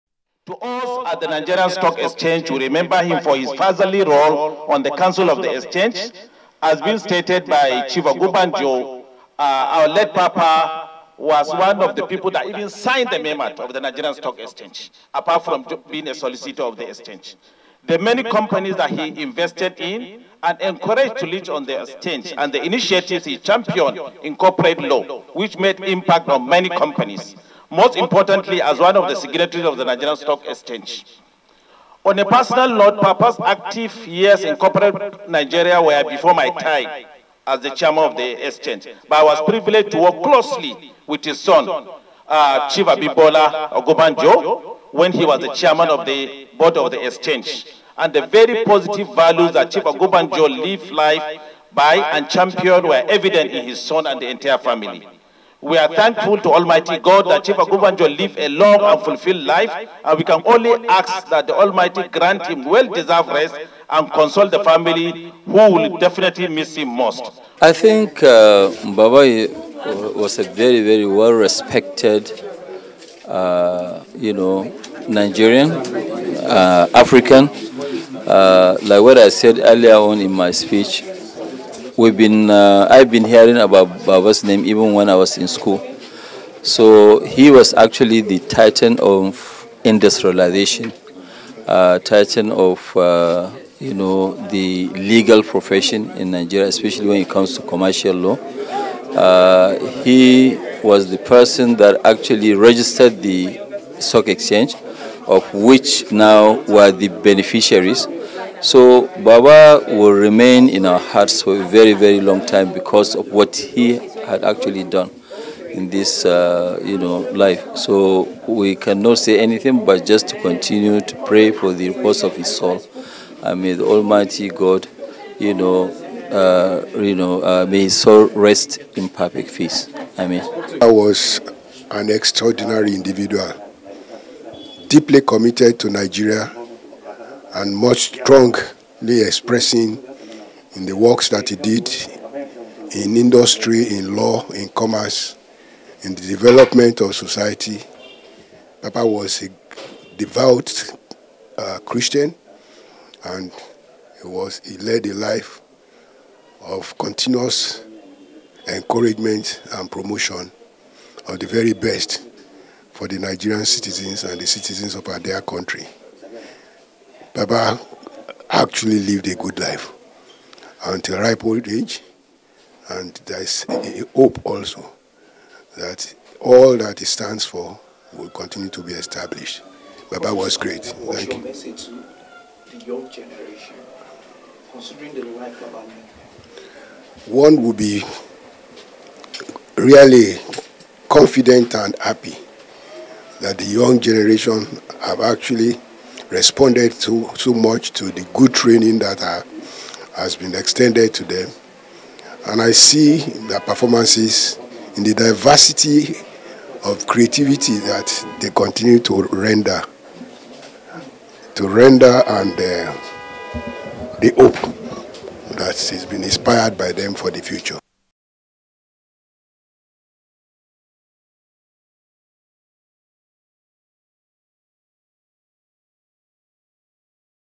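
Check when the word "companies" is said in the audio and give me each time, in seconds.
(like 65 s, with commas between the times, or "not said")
18 s, 26 s.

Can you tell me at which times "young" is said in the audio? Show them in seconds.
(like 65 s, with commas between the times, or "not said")
182 s, 193 s.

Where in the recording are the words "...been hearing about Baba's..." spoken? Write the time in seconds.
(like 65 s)
83 s.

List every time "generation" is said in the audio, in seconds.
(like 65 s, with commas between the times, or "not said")
183 s, 194 s.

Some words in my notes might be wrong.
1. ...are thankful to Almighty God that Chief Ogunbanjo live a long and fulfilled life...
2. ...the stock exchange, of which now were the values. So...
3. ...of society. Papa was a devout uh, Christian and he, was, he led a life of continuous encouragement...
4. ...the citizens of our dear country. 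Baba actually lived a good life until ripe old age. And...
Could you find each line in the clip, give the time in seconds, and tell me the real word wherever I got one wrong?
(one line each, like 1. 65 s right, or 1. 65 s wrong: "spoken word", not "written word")
1. 55 s right
2. 103 s wrong: "beneficiaries", not "values"
3. 147 s right
4. 164 s right.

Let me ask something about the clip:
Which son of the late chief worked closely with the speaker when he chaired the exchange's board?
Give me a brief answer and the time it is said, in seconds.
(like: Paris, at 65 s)
Abimbola Ogunbanjo, at 42 s.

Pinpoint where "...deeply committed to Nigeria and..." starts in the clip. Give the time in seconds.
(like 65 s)
134 s.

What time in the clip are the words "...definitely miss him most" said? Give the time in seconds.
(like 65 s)
65 s.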